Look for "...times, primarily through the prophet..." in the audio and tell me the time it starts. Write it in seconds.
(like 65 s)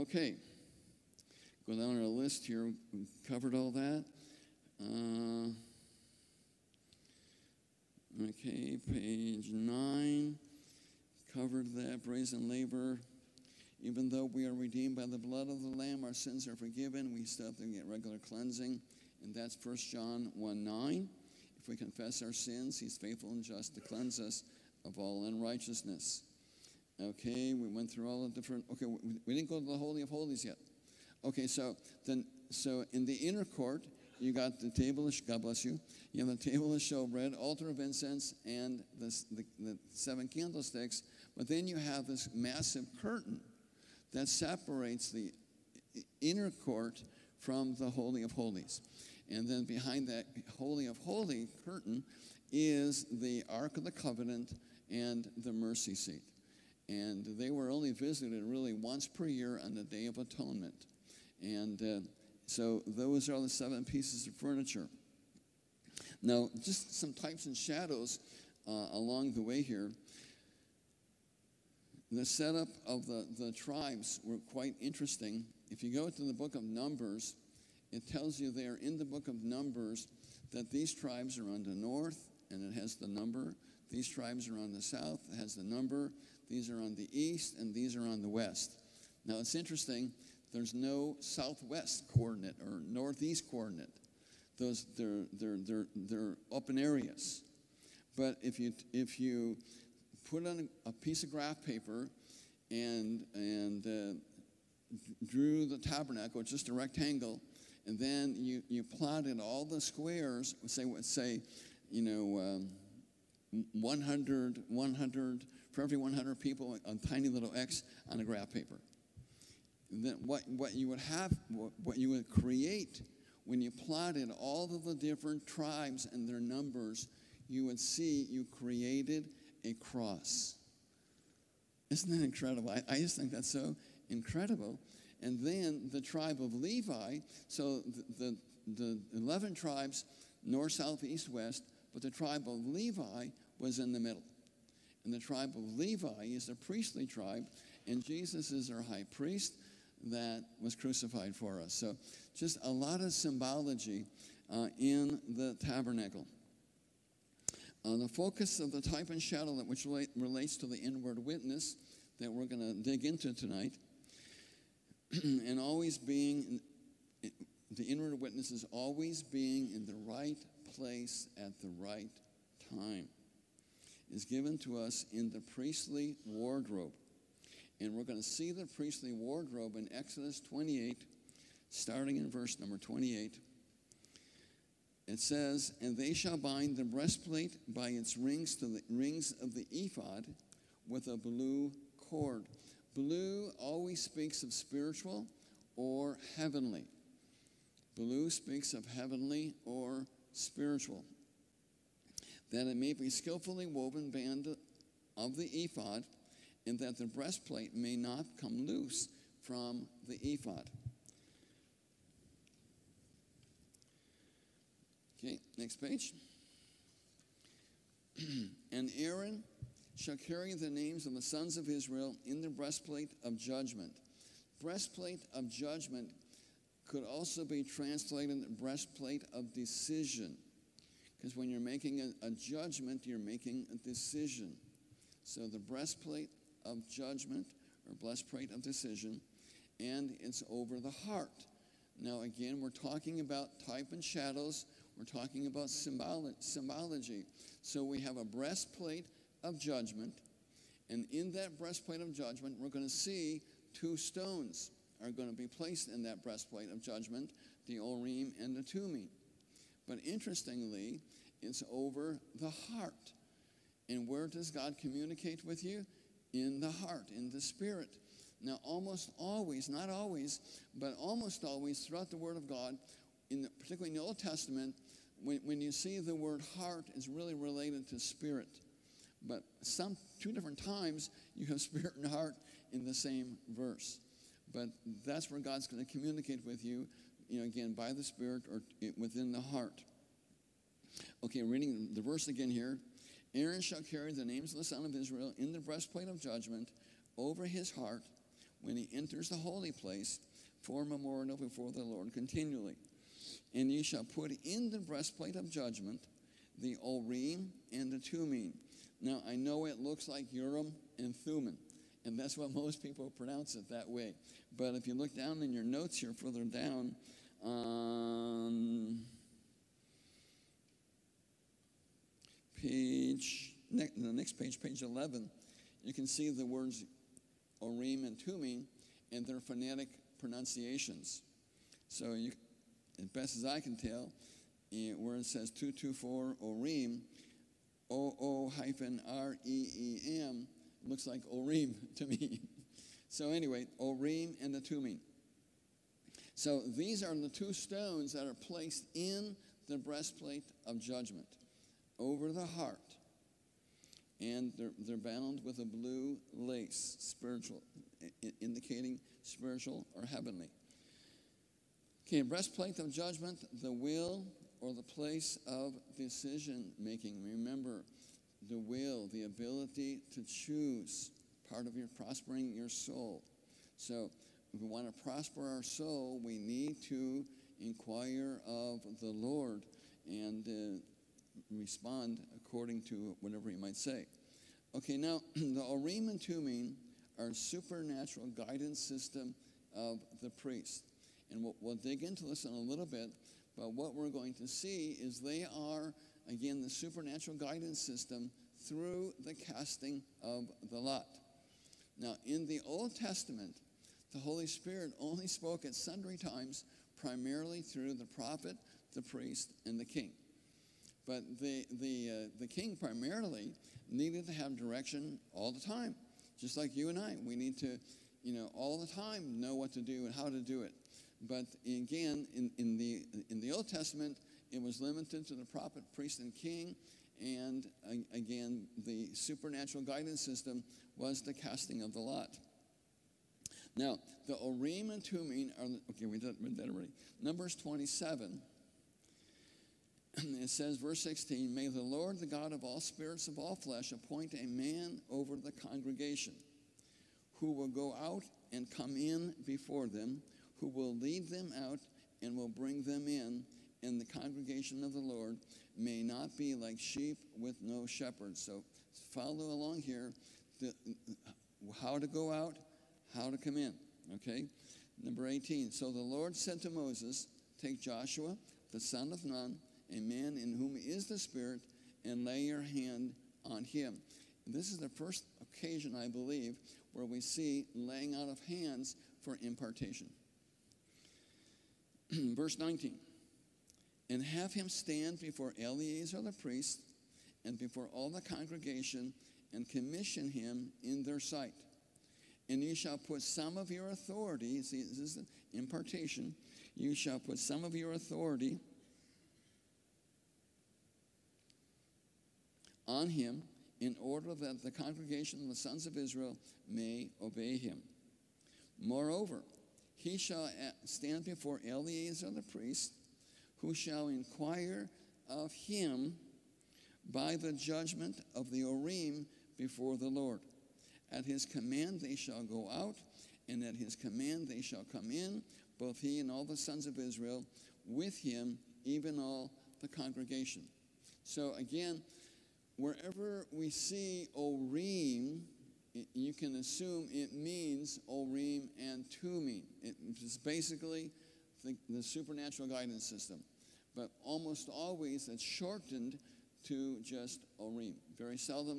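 406 s.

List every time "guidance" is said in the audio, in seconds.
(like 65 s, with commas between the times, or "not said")
388 s, 397 s, 429 s, 542 s.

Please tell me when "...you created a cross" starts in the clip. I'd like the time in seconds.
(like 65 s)
128 s.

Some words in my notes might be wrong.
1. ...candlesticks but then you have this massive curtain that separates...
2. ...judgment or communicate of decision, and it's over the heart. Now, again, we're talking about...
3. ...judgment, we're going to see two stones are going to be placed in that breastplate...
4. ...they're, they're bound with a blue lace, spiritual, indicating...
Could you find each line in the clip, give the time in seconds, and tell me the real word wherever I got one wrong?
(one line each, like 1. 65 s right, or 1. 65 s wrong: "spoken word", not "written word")
1. 40 s right
2. 236 s wrong: "breastplate", not "communicate"
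3. 252 s right
4. 354 s right.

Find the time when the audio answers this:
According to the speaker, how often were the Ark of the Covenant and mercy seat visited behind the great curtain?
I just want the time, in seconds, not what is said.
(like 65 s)
58 s.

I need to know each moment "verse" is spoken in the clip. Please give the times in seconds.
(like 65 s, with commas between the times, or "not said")
182 s, 283 s, 292 s, 440 s, 482 s.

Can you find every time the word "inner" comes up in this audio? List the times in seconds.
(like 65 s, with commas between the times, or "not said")
33 s, 46 s.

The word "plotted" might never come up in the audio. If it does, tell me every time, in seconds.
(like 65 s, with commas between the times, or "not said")
108 s, 123 s.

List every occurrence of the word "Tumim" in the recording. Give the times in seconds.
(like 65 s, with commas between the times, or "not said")
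258 s, 307 s, 328 s, 344 s, 386 s, 435 s, 539 s.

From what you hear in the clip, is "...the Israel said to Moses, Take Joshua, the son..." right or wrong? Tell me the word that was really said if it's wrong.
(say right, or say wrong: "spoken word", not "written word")
wrong: "Lord", not "Israel".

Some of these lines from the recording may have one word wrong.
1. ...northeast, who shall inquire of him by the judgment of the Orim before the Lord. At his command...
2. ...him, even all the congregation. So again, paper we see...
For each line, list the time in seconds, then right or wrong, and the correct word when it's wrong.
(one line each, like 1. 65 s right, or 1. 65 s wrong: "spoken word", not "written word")
1. 512 s wrong: "priest", not "northeast"
2. 528 s wrong: "wherever", not "paper".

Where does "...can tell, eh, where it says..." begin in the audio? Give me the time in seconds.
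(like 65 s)
333 s.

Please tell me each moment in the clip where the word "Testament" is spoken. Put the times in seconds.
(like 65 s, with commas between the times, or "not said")
274 s, 402 s, 423 s.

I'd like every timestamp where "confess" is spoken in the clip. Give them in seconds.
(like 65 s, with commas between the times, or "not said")
21 s.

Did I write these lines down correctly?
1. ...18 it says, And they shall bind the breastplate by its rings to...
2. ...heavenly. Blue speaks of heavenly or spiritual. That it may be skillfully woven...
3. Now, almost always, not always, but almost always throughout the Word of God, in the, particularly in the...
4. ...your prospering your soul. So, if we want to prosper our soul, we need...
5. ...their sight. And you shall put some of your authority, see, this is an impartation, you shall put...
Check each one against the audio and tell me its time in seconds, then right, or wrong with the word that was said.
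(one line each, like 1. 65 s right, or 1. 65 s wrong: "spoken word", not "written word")
1. 182 s wrong: "28", not "18"
2. 196 s right
3. 268 s right
4. 371 s right
5. 491 s right.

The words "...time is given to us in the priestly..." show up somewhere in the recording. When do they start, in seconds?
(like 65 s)
172 s.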